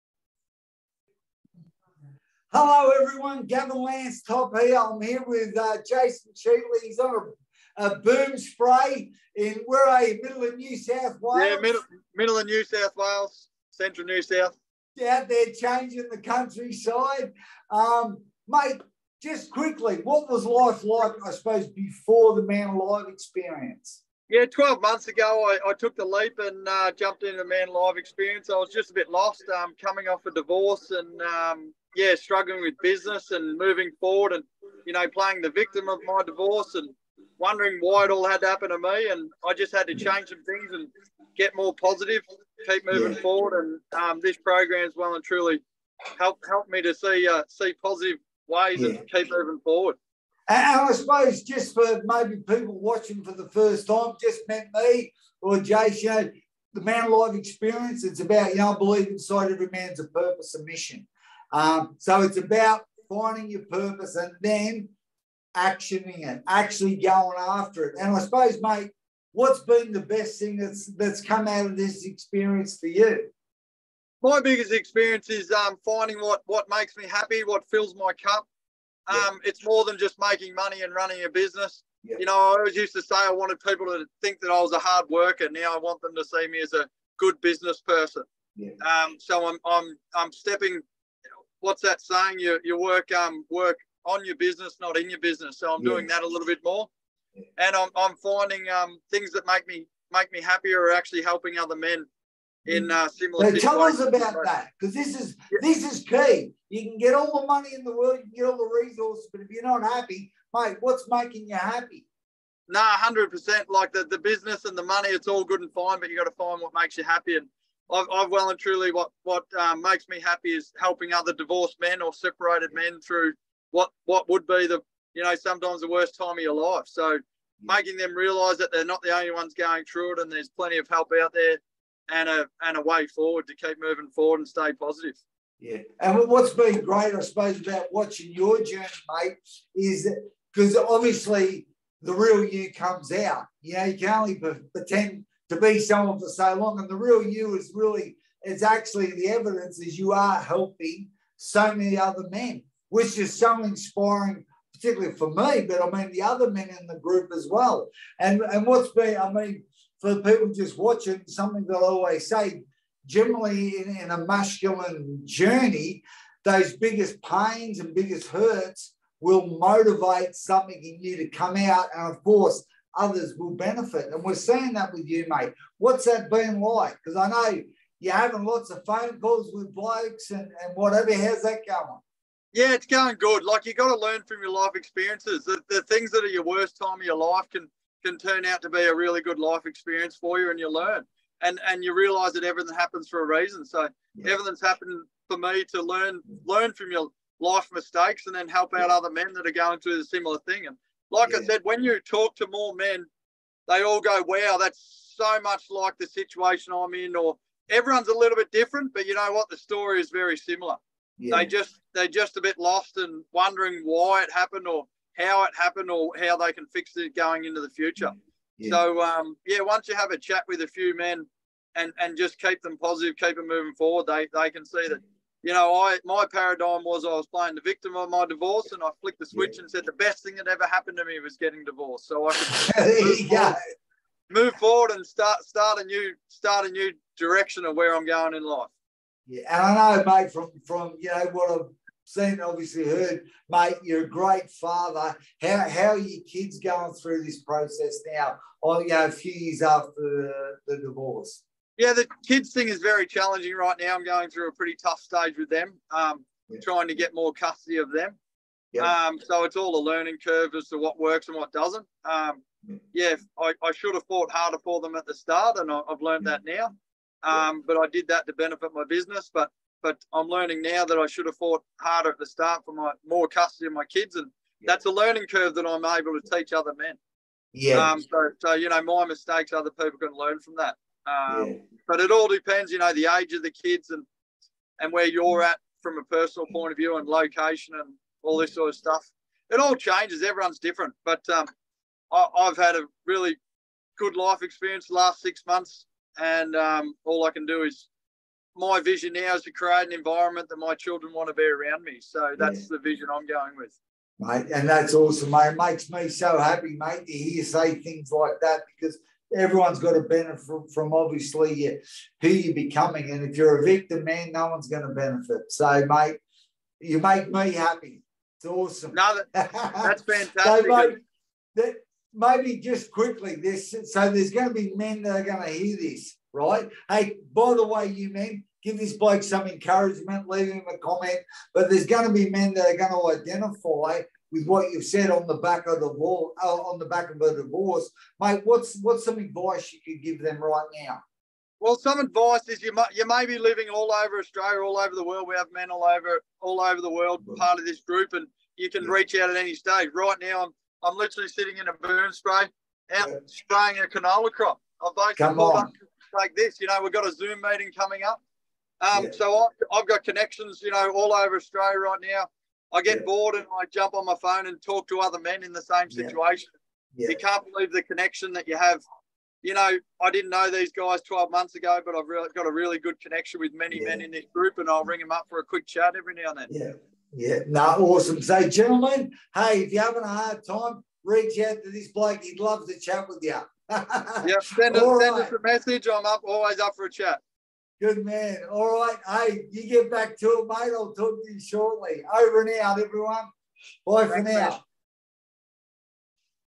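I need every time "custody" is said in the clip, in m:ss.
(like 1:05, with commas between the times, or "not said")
4:17, 4:33.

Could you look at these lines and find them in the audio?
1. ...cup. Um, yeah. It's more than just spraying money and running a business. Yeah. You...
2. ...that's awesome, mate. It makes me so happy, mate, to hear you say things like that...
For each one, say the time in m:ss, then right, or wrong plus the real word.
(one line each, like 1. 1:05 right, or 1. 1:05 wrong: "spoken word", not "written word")
1. 1:18 wrong: "making", not "spraying"
2. 5:04 right.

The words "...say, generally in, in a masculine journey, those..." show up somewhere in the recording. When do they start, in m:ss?
2:42.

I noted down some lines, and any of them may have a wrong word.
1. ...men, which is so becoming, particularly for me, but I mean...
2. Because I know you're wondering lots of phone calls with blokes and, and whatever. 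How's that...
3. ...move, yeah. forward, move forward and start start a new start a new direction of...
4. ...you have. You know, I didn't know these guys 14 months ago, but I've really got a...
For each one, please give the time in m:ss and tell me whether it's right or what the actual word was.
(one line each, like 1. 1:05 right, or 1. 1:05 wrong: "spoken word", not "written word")
1. 2:32 wrong: "inspiring", not "becoming"
2. 2:57 wrong: "having", not "wondering"
3. 3:53 right
4. 6:08 wrong: "12", not "14".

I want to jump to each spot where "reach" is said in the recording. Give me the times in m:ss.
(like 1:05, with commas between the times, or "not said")
5:48, 6:21.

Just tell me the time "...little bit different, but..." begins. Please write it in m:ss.
3:28.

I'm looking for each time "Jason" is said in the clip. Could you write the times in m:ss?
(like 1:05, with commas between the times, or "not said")
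0:05, 0:55.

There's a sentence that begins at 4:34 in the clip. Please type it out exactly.
that's a learning curve that I'm able to teach other men.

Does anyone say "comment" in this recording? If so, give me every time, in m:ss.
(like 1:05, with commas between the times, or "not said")
5:30.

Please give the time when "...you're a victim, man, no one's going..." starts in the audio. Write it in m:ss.
5:13.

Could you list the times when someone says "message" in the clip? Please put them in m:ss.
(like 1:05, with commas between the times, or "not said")
6:25.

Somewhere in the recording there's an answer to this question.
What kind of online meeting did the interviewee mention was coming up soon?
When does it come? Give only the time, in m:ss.
5:57.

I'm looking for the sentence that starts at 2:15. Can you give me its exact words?
Yeah, and what's been great, I suppose, about watching your journey, mate, is because obviously the real you comes out.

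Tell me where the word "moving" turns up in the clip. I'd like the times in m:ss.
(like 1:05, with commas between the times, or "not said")
0:33, 0:42, 0:49, 2:13, 3:43.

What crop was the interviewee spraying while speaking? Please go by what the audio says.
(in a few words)
Canola.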